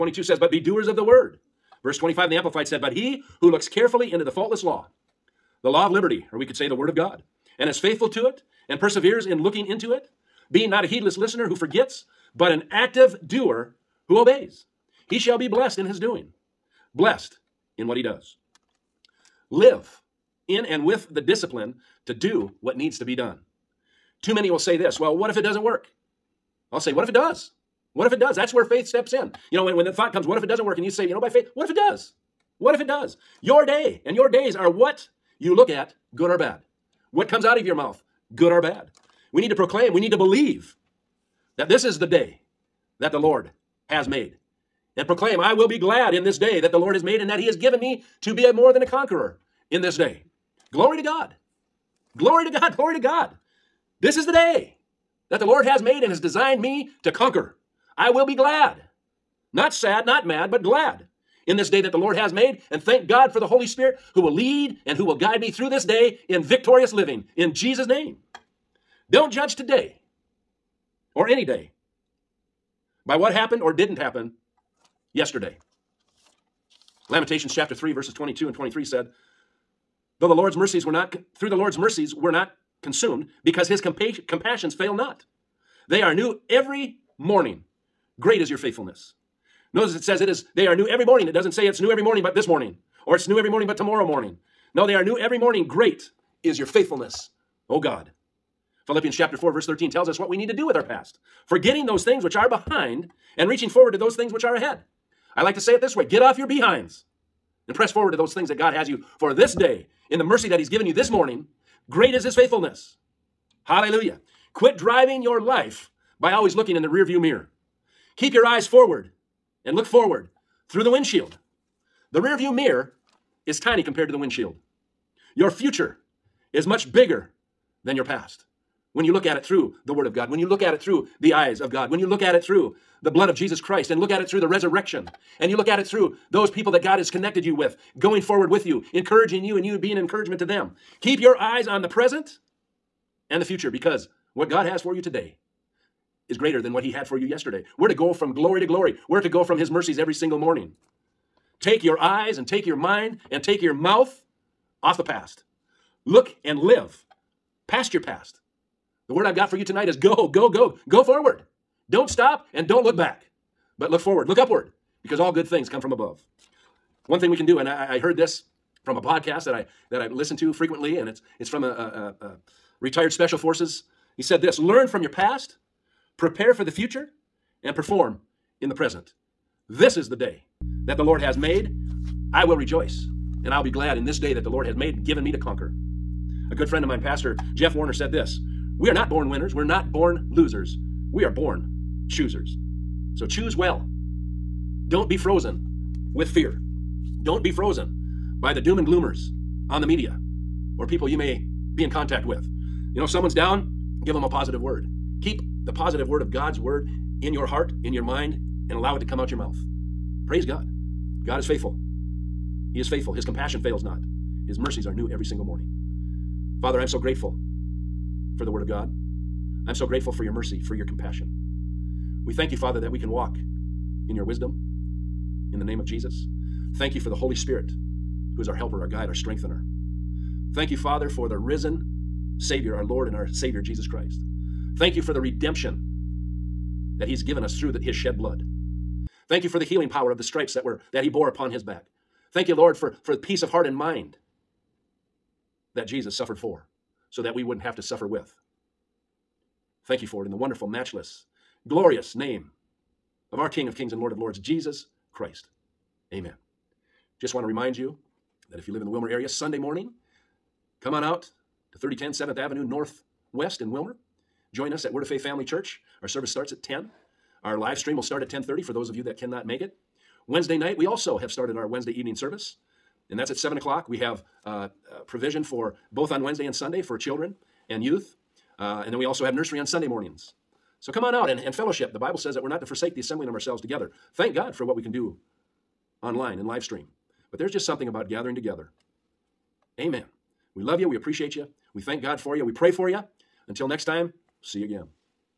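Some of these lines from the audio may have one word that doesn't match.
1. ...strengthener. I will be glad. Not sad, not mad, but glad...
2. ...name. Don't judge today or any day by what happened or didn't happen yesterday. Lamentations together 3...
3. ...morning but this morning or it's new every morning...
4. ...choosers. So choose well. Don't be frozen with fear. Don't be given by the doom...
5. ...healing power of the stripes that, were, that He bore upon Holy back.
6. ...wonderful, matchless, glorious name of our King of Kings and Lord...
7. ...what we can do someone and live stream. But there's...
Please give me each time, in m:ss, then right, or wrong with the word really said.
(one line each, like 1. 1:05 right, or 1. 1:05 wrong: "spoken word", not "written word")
1. 0:57 wrong: "conquer", not "strengthener"
2. 1:07 wrong: "chapter", not "together"
3. 1:32 right
4. 3:12 wrong: "frozen", not "given"
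5. 3:59 wrong: "His", not "Holy"
6. 4:10 right
7. 4:44 wrong: "online", not "someone".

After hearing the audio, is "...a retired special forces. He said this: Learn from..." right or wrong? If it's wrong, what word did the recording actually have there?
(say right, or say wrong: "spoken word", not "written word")
right.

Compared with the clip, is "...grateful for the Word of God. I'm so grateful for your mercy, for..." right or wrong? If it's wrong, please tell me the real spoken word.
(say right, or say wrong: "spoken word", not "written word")
right.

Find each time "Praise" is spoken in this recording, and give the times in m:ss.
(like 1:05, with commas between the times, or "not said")
3:30.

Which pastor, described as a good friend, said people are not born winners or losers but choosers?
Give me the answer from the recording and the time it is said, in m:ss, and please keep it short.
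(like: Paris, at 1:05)
Jeff Warner, at 3:07.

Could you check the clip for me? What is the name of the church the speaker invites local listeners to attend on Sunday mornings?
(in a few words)
Word of Faith Family Church.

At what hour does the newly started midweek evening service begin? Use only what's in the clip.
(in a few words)
7 o'clock.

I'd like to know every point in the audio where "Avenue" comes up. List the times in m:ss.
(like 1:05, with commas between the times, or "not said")
4:22.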